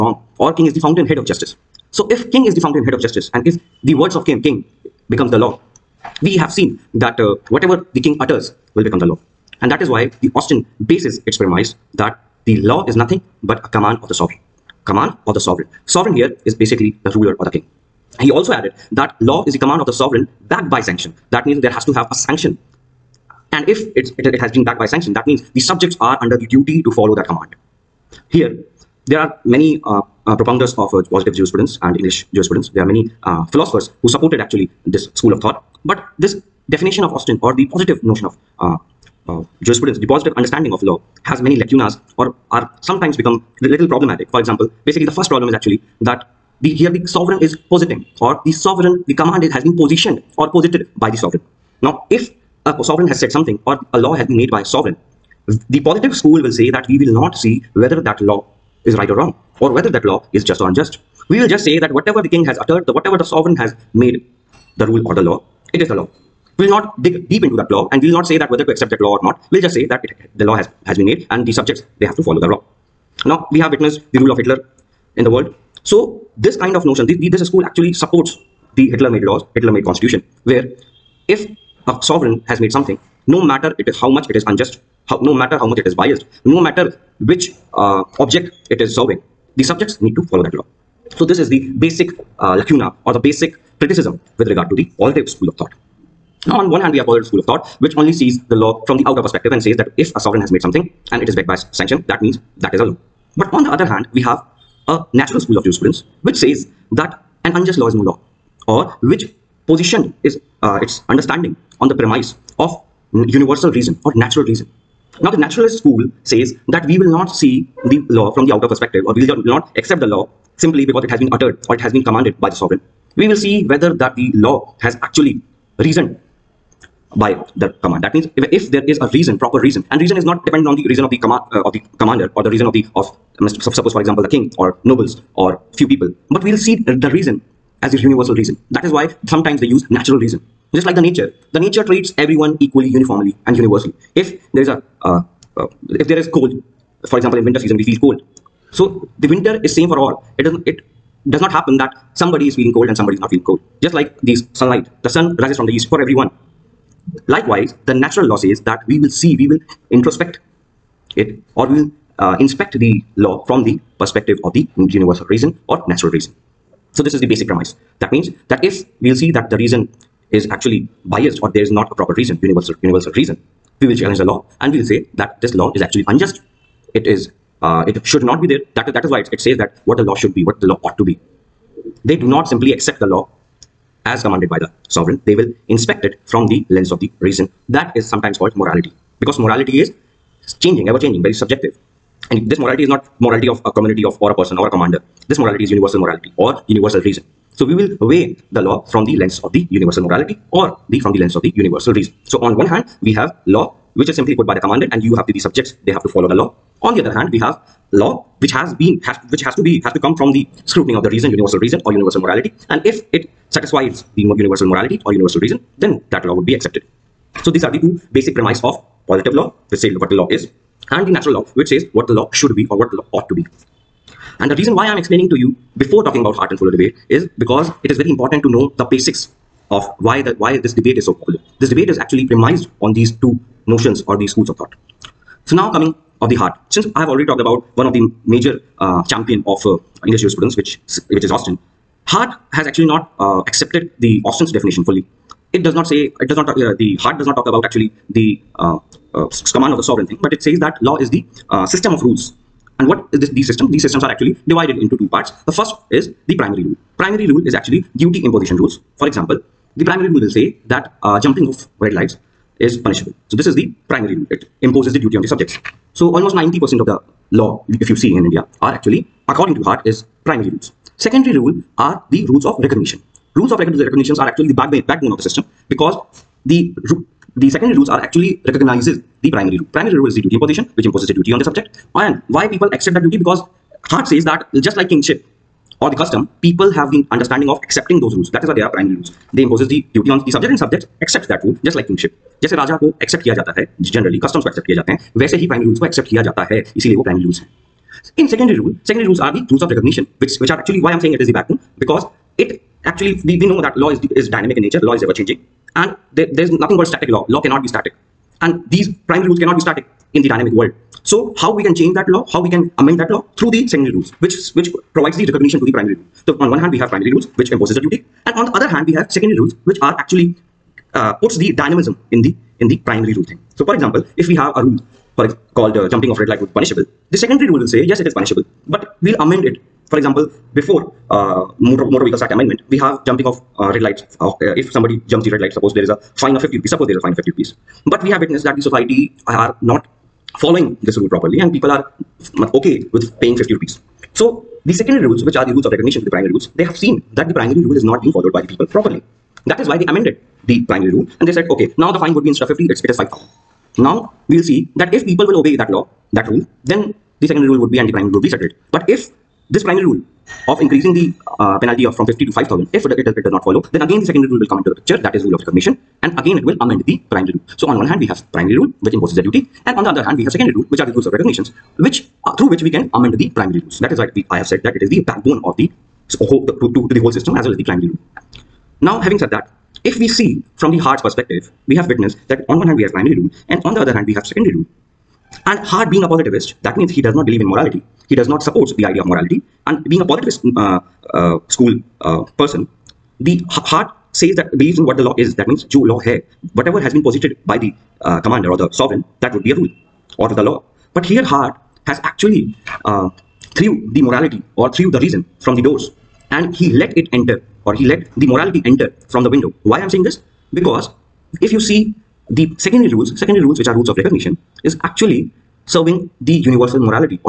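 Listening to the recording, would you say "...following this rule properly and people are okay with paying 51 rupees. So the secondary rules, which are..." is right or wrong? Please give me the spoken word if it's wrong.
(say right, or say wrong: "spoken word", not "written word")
wrong: "50", not "51".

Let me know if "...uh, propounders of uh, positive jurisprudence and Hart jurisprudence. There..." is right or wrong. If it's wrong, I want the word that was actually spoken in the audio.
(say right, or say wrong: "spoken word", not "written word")
wrong: "English", not "Hart".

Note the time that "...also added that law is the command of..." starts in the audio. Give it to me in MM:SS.
00:18.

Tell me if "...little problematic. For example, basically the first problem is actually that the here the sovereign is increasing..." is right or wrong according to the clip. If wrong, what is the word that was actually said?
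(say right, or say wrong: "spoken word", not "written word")
wrong: "positing", not "increasing".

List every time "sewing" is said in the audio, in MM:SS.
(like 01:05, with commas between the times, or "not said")
not said.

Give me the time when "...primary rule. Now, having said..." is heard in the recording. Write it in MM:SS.
06:17.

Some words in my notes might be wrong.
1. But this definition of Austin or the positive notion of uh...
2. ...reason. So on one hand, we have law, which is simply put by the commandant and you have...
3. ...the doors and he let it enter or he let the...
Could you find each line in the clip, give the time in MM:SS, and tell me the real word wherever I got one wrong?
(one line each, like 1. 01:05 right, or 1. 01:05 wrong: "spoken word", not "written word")
1. 00:35 right
2. 03:21 right
3. 06:45 right.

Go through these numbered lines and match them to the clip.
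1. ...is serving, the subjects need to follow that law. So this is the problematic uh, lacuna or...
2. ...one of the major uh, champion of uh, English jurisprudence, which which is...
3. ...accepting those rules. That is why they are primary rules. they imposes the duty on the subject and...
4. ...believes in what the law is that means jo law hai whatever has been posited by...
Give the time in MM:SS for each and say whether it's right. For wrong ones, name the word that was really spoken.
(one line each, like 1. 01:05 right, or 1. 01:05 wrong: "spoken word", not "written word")
1. 01:28 wrong: "basic", not "problematic"
2. 03:57 right
3. 04:47 right
4. 06:34 right.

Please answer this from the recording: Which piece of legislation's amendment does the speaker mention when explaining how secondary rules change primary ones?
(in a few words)
Motor Vehicles Act.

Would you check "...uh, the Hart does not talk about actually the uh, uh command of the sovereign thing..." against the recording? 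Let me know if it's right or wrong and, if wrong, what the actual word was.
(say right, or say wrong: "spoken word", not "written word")
right.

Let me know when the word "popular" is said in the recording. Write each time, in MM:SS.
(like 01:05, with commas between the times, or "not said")
03:51.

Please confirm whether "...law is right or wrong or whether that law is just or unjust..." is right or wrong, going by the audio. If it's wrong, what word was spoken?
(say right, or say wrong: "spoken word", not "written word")
right.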